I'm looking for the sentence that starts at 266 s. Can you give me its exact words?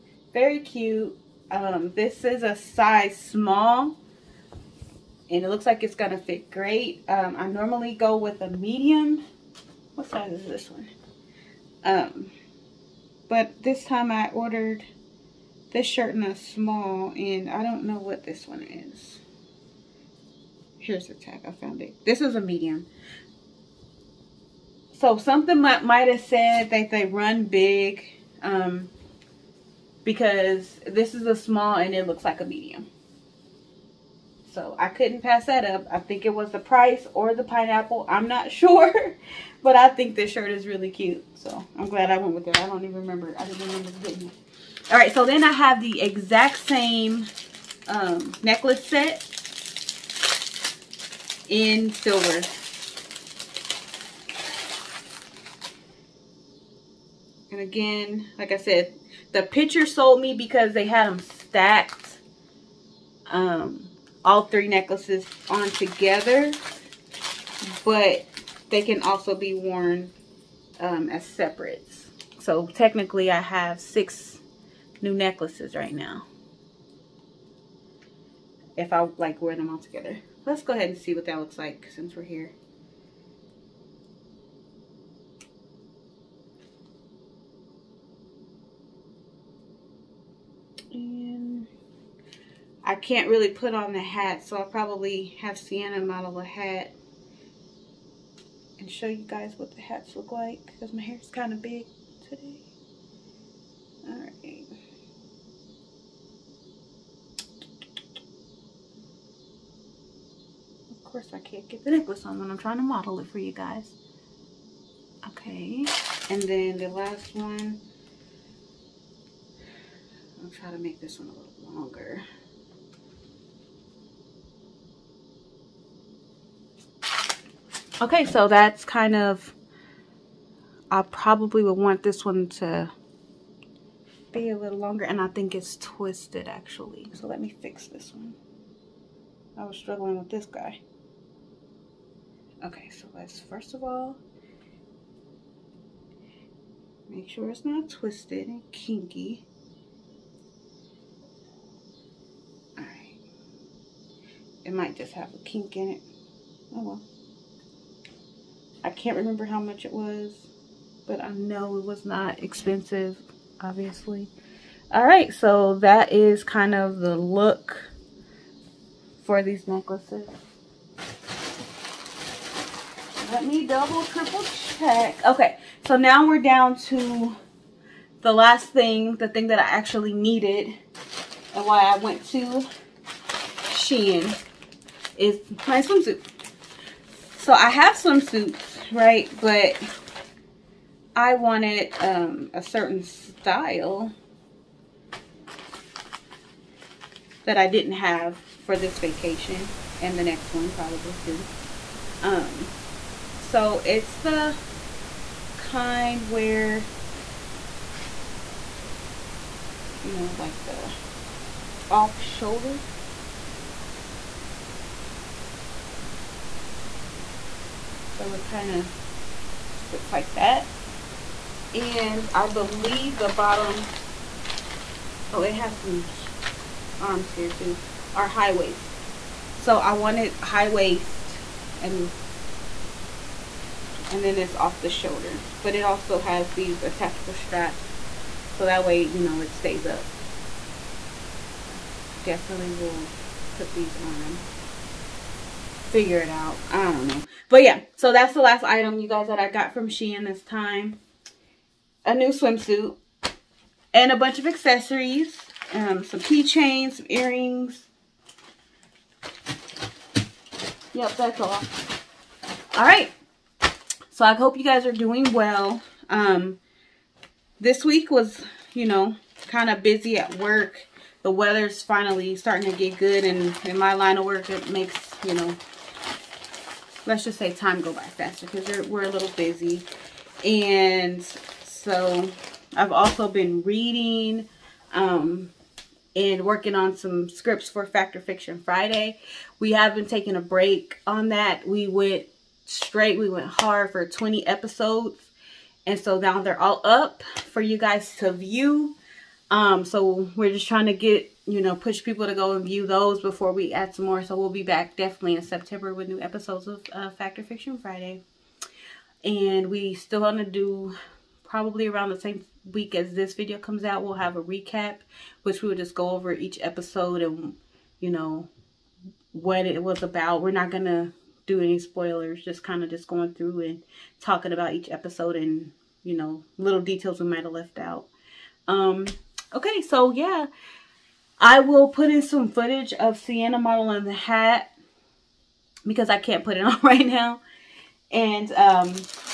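Um, this week was, you know, kind of busy at work.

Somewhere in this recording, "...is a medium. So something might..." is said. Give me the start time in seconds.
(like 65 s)
22 s.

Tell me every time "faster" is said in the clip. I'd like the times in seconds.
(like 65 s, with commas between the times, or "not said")
278 s.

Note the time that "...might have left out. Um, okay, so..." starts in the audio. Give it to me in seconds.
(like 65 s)
327 s.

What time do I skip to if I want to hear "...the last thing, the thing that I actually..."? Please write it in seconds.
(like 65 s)
178 s.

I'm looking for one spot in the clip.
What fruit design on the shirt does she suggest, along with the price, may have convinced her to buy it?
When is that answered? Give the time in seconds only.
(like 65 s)
37 s.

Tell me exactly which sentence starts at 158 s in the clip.
I can't remember how much it was, but I know it was not expensive, obviously.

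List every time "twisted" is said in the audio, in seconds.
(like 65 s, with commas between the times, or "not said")
135 s, 147 s.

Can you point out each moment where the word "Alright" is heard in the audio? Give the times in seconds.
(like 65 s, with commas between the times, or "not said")
152 s, 164 s.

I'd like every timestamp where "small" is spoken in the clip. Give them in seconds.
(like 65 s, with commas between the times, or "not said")
3 s, 16 s, 31 s.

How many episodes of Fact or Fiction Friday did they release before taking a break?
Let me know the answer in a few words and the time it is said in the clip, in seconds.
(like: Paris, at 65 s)
20, at 294 s.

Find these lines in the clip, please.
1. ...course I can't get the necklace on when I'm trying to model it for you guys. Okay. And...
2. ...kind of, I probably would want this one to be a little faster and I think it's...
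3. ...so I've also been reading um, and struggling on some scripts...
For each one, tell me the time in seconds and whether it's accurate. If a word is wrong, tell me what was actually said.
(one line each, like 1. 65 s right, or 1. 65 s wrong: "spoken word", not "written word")
1. 111 s right
2. 128 s wrong: "longer", not "faster"
3. 281 s wrong: "working", not "struggling".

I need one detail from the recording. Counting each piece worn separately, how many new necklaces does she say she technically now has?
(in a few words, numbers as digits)
6.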